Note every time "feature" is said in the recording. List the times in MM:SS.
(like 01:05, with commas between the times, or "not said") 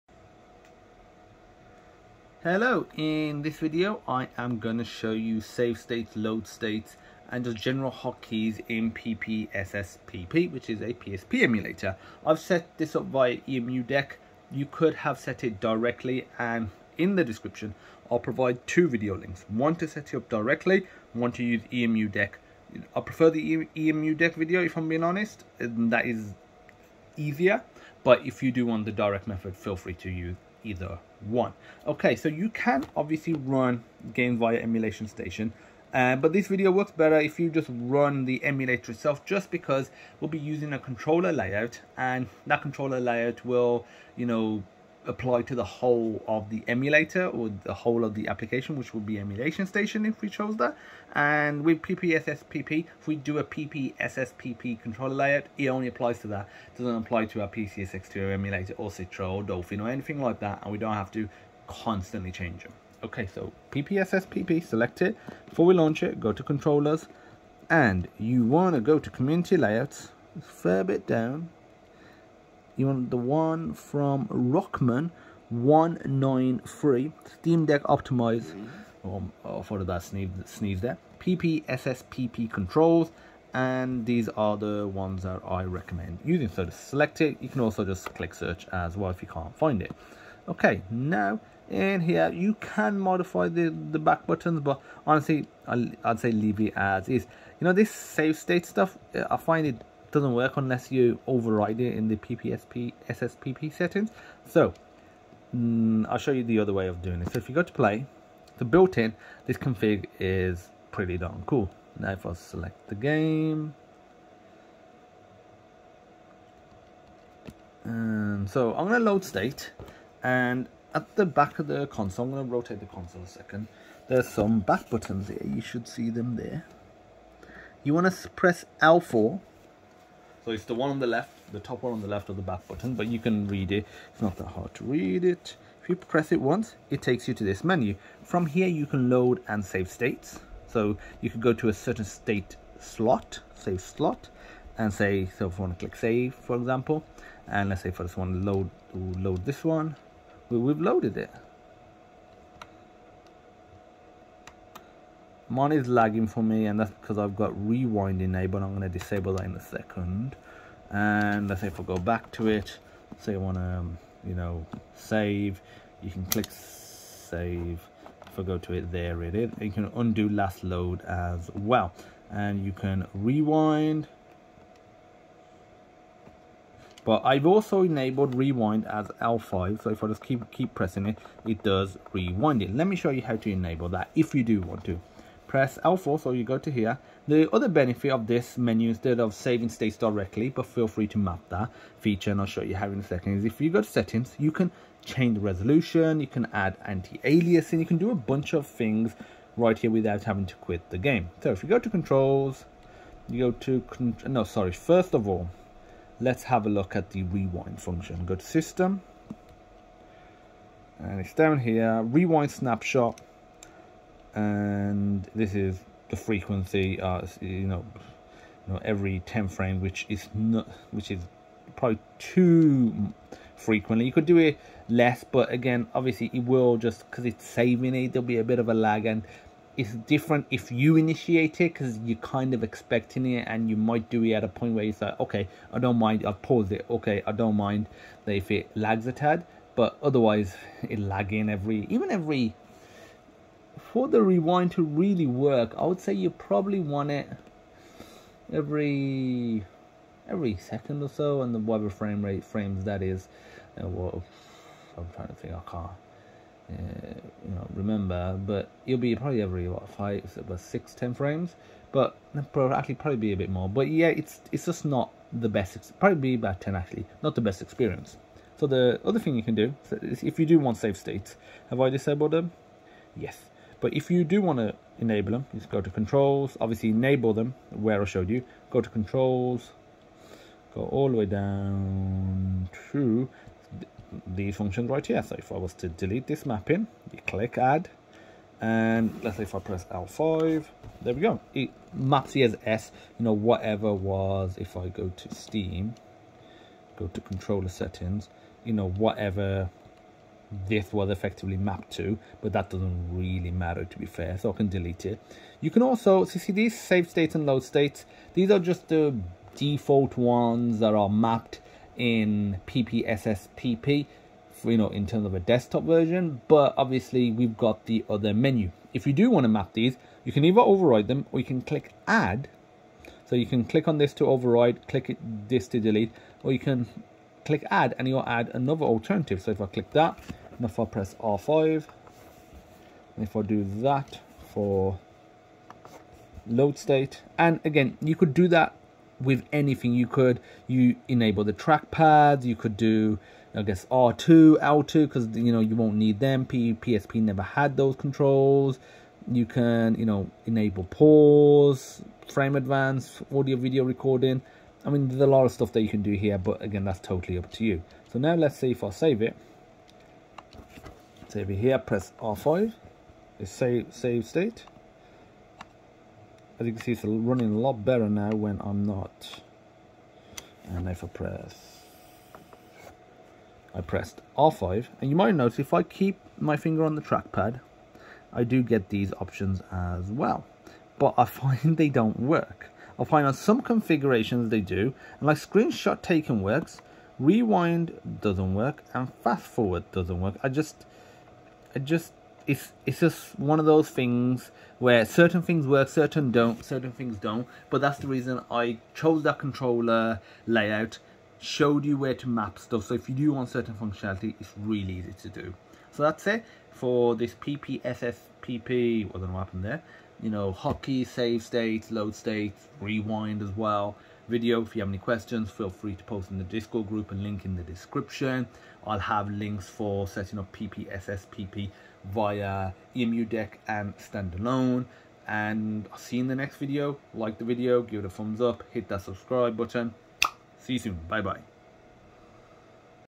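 03:11.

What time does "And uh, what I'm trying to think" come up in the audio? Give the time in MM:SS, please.
04:13.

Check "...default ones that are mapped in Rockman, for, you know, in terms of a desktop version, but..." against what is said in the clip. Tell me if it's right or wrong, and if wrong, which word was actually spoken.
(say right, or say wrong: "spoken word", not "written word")
wrong: "PPSSPP", not "Rockman".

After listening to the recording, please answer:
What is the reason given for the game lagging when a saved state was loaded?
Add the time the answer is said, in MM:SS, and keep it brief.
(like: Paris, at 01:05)
rewind enabled, at 02:37.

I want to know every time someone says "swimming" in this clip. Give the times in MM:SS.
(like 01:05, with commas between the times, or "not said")
not said.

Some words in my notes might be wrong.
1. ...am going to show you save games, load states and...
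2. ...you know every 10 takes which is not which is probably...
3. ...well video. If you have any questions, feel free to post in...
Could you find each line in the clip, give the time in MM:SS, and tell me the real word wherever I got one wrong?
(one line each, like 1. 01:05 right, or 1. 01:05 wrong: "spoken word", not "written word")
1. 00:04 wrong: "states", not "games"
2. 03:38 wrong: "frames", not "takes"
3. 06:53 right.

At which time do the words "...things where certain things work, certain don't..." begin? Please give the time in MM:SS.
06:33.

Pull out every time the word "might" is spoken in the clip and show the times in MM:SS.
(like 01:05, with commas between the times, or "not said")
03:53, 06:15.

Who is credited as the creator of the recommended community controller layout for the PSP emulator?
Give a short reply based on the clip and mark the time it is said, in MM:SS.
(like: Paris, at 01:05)
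Rockman 193, at 01:14.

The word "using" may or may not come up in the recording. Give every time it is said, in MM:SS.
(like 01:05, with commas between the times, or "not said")
00:40, 01:26.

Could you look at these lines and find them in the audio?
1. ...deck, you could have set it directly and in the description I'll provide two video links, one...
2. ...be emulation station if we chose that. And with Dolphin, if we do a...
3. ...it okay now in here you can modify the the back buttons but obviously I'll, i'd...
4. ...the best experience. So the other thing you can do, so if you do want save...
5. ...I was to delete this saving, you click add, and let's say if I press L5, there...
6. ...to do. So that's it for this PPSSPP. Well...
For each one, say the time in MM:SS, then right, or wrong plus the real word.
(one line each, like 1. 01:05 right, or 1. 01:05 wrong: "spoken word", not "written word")
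1. 00:13 right
2. 00:49 wrong: "PPSSPP", not "Dolphin"
3. 01:29 wrong: "honestly", not "obviously"
4. 04:27 right
5. 04:45 wrong: "mapping", not "saving"
6. 06:45 right.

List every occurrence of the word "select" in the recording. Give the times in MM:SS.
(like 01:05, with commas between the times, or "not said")
01:04, 01:26, 01:52.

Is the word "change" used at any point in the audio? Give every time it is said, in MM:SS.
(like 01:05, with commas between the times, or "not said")
01:02, 03:15.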